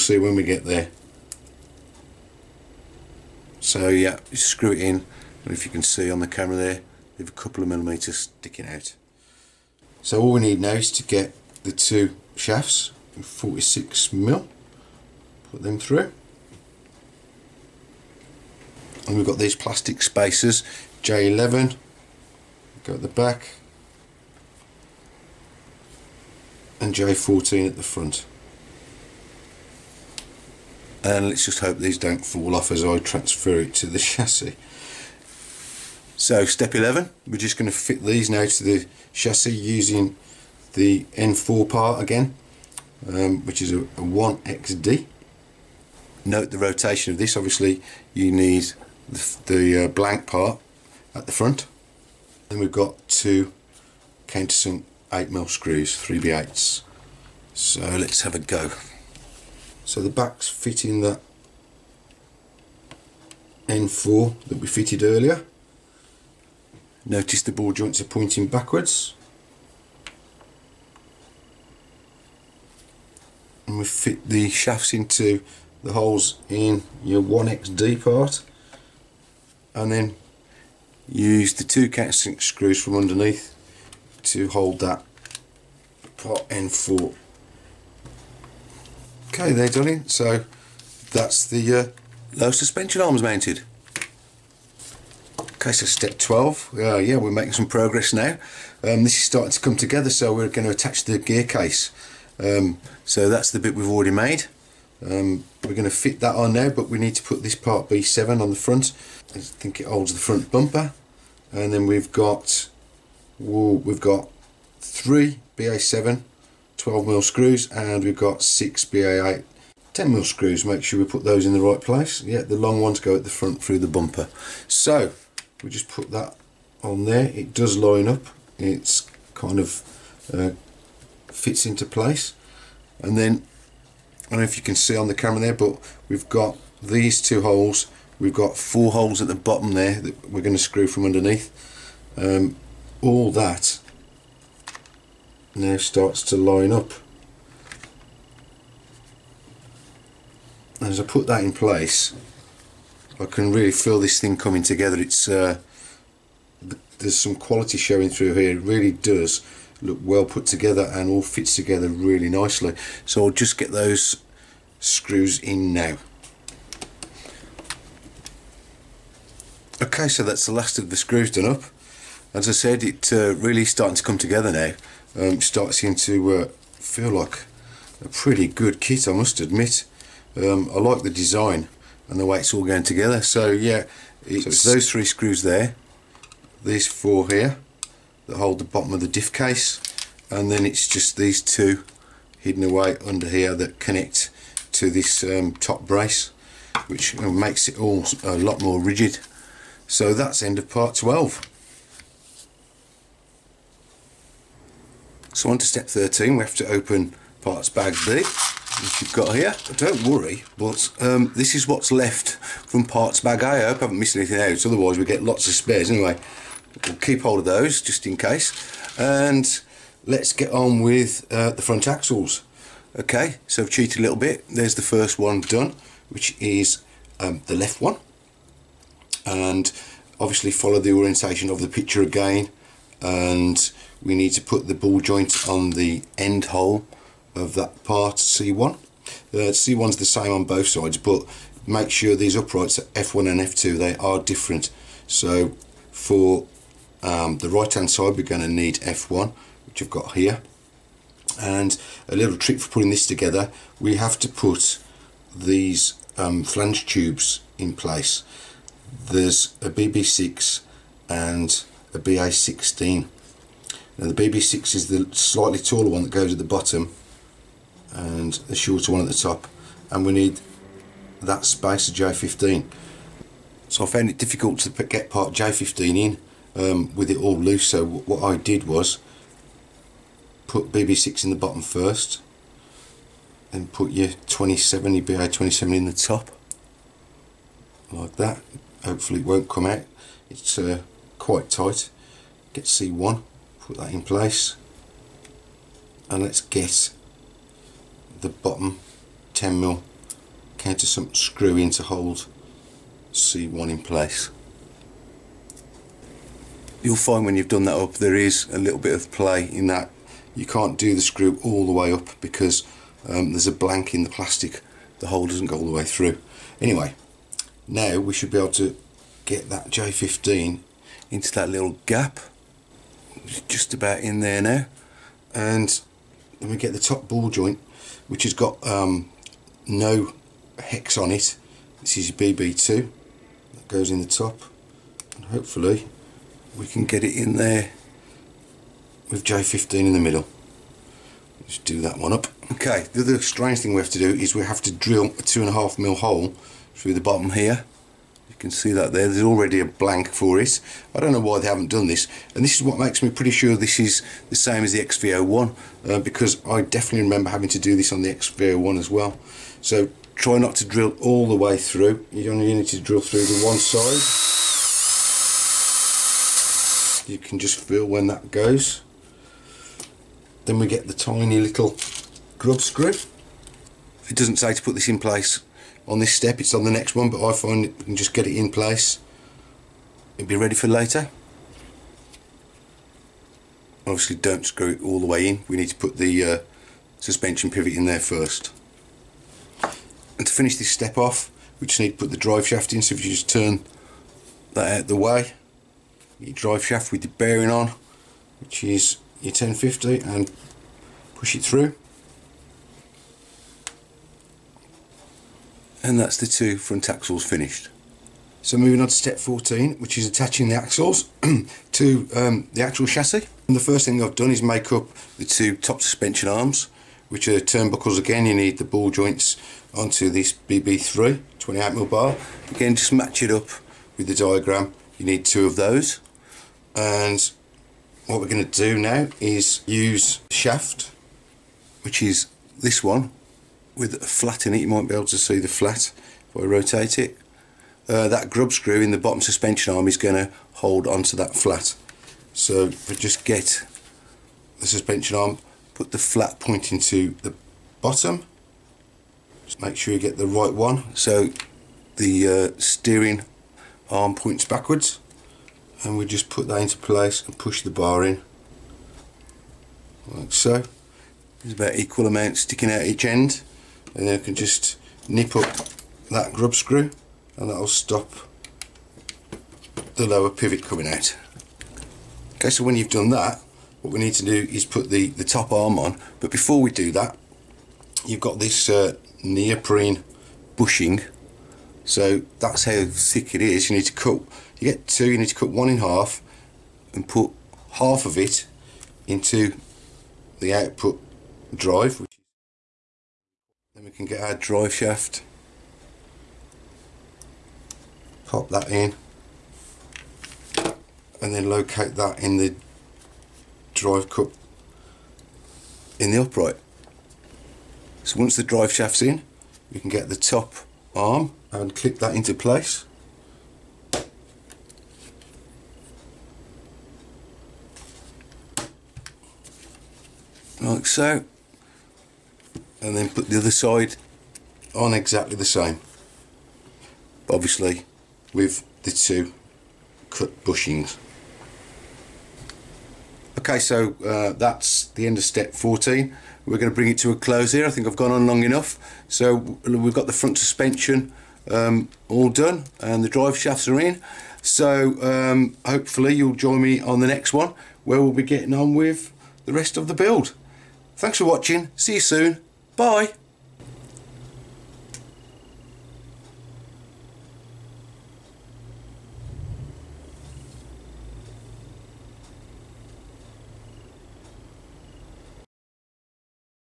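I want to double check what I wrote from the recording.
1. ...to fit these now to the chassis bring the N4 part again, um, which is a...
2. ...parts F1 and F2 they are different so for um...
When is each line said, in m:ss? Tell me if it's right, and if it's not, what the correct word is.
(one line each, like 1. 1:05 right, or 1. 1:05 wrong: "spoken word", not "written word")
1. 0:37 wrong: "using", not "bring"
2. 4:02 wrong: "uprights", not "parts".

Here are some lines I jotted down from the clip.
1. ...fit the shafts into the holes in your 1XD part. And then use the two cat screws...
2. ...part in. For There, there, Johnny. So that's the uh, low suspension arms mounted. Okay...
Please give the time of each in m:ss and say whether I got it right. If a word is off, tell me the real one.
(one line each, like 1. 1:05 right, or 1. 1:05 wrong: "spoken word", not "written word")
1. 1:13 right
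2. 1:26 wrong: "Okay", not "There".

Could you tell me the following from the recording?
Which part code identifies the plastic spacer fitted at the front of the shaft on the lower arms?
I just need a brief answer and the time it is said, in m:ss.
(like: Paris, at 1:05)
J14, at 0:26.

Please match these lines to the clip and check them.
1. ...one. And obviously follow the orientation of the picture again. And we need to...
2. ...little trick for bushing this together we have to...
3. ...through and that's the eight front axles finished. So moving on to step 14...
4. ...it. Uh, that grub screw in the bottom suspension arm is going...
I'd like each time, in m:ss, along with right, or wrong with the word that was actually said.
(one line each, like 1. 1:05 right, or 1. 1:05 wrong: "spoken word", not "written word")
1. 3:47 right
2. 4:12 wrong: "putting", not "bushing"
3. 6:41 wrong: "two", not "eight"
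4. 7:16 right.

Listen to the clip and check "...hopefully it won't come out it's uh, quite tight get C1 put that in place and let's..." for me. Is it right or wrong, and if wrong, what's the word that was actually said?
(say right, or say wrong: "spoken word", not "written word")
right.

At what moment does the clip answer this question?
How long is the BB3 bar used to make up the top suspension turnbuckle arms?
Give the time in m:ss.
7:01.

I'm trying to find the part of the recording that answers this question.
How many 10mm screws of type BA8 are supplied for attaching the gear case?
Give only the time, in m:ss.
1:58.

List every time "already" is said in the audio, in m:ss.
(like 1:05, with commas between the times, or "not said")
1:43, 5:49.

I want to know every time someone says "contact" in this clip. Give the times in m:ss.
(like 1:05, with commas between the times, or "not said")
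not said.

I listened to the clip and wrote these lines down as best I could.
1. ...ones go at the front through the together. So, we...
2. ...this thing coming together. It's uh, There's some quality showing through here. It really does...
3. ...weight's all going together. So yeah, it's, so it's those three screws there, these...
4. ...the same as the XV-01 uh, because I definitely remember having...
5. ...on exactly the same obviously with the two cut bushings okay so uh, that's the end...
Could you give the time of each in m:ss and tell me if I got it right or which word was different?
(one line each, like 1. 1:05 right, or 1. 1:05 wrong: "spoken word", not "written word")
1. 2:02 wrong: "bumper", not "together"
2. 2:34 right
3. 3:02 right
4. 5:54 right
5. 8:44 right.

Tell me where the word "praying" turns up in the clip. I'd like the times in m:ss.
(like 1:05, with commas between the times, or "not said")
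not said.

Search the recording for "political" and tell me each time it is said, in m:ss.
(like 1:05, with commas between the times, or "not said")
not said.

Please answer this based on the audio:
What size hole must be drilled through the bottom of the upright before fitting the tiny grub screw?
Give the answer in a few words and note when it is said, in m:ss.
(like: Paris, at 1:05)
2.5 mm, at 5:45.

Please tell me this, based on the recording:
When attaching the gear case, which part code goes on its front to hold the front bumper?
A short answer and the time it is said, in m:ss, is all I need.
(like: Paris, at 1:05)
B7, at 1:47.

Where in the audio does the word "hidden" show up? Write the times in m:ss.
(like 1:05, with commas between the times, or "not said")
3:12.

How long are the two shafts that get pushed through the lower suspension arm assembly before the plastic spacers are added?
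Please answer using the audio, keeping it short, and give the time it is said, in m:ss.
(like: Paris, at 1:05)
46 mm, at 0:13.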